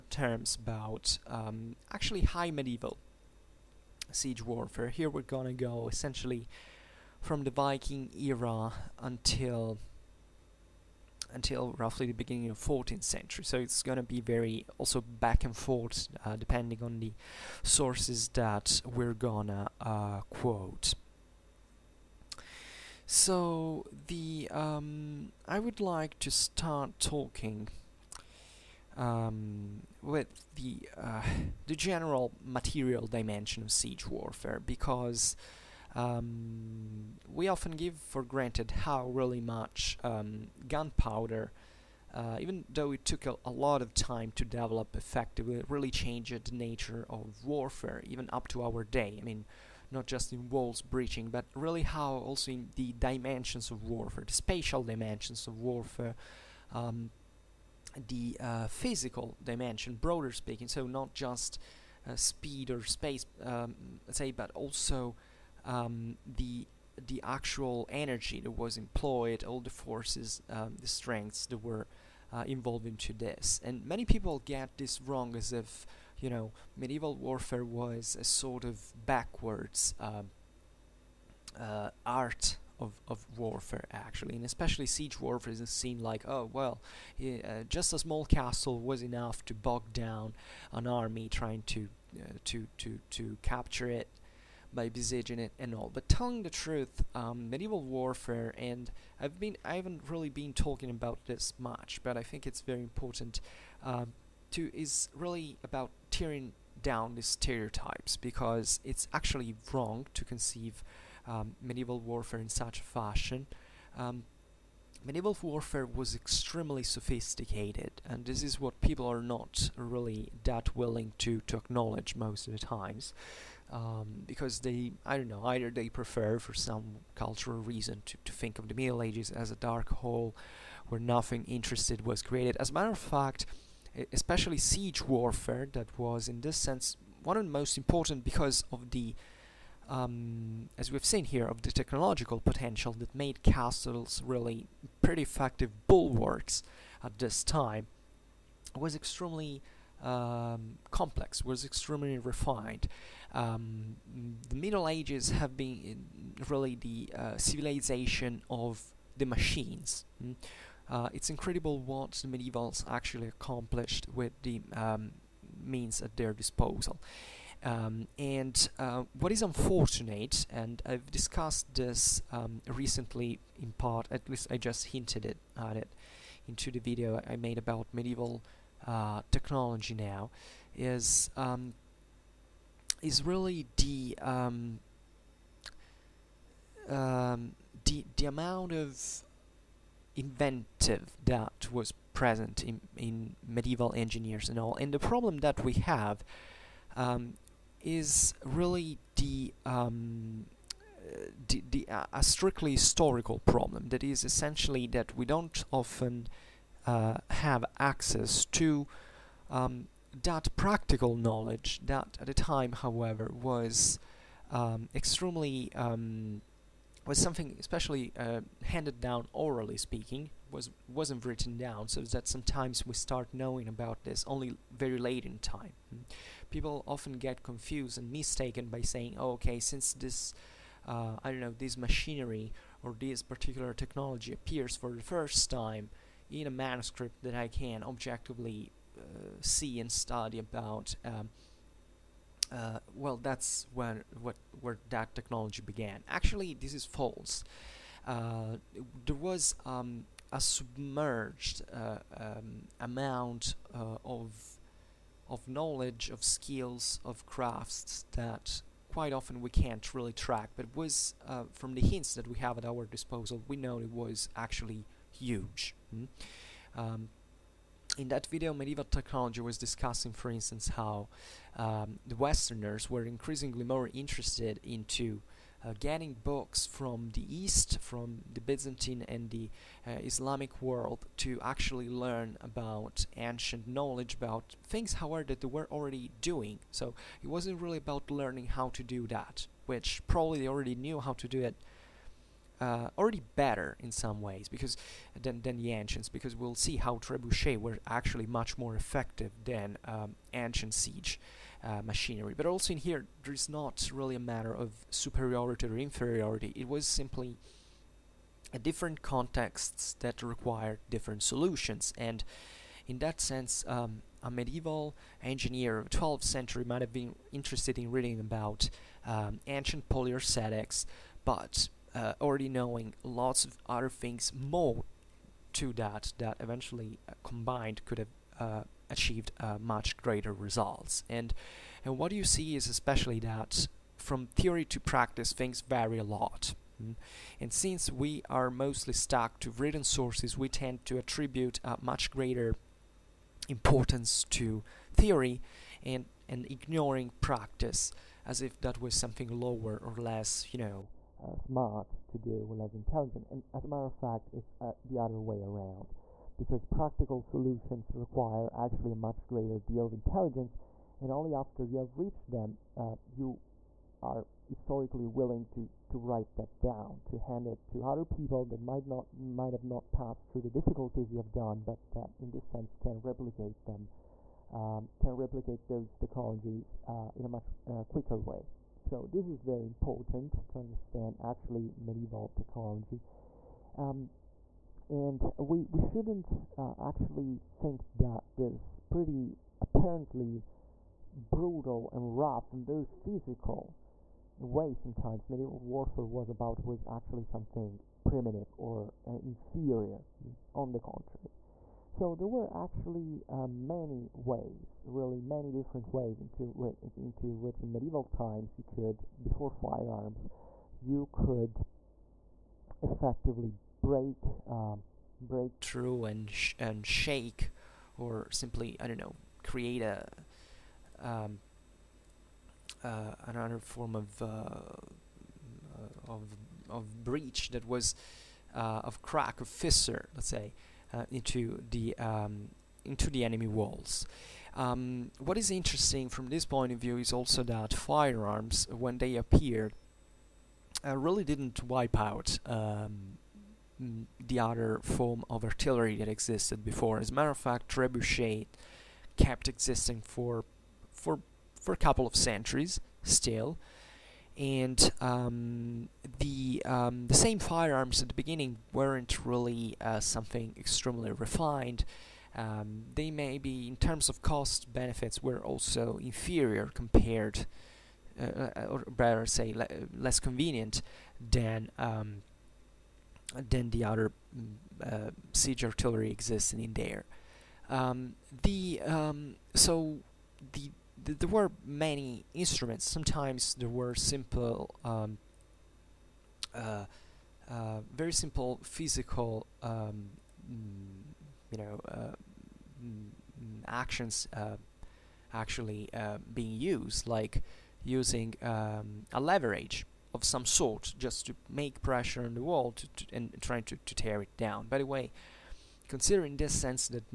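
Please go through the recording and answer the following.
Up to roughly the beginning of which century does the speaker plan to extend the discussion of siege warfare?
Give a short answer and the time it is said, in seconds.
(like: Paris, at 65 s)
14th century, at 12 s.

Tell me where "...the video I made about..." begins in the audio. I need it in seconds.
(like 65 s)
176 s.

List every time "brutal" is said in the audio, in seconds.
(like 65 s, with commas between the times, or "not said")
391 s.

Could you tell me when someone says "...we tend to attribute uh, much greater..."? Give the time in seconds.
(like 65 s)
340 s.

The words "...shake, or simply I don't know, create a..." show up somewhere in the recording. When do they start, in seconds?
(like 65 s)
416 s.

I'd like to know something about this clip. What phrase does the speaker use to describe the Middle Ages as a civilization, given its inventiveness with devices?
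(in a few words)
civilization of the machines.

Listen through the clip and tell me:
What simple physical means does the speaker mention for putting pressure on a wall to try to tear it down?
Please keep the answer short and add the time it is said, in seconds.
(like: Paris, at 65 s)
leverage, at 499 s.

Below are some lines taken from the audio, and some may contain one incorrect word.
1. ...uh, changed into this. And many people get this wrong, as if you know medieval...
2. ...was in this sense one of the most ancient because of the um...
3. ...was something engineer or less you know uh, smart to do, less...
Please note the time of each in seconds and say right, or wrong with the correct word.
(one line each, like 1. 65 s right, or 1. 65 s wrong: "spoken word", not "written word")
1. 72 s wrong: "involved", not "changed"
2. 135 s wrong: "important", not "ancient"
3. 348 s wrong: "lower", not "engineer".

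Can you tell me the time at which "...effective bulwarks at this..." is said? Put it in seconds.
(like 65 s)
145 s.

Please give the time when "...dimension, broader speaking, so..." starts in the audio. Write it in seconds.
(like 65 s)
59 s.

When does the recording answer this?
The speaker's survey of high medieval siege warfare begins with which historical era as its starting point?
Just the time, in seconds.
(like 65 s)
7 s.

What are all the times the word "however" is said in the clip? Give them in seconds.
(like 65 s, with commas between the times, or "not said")
212 s, 284 s.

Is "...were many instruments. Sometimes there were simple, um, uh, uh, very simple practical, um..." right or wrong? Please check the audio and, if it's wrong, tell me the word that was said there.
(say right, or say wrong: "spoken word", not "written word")
wrong: "physical", not "practical".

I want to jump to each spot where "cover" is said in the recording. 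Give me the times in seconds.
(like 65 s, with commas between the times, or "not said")
not said.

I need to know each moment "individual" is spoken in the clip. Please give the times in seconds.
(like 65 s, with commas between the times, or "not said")
not said.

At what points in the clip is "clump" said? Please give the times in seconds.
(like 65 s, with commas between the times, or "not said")
not said.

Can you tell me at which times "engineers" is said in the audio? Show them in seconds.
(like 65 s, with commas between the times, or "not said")
193 s, 315 s.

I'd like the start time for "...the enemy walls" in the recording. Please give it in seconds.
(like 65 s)
433 s.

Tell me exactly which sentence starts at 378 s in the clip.
So this is very important to understand actually medieval technology.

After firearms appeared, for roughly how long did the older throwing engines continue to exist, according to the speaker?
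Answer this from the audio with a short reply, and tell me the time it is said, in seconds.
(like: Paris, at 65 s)
a couple of centuries, at 451 s.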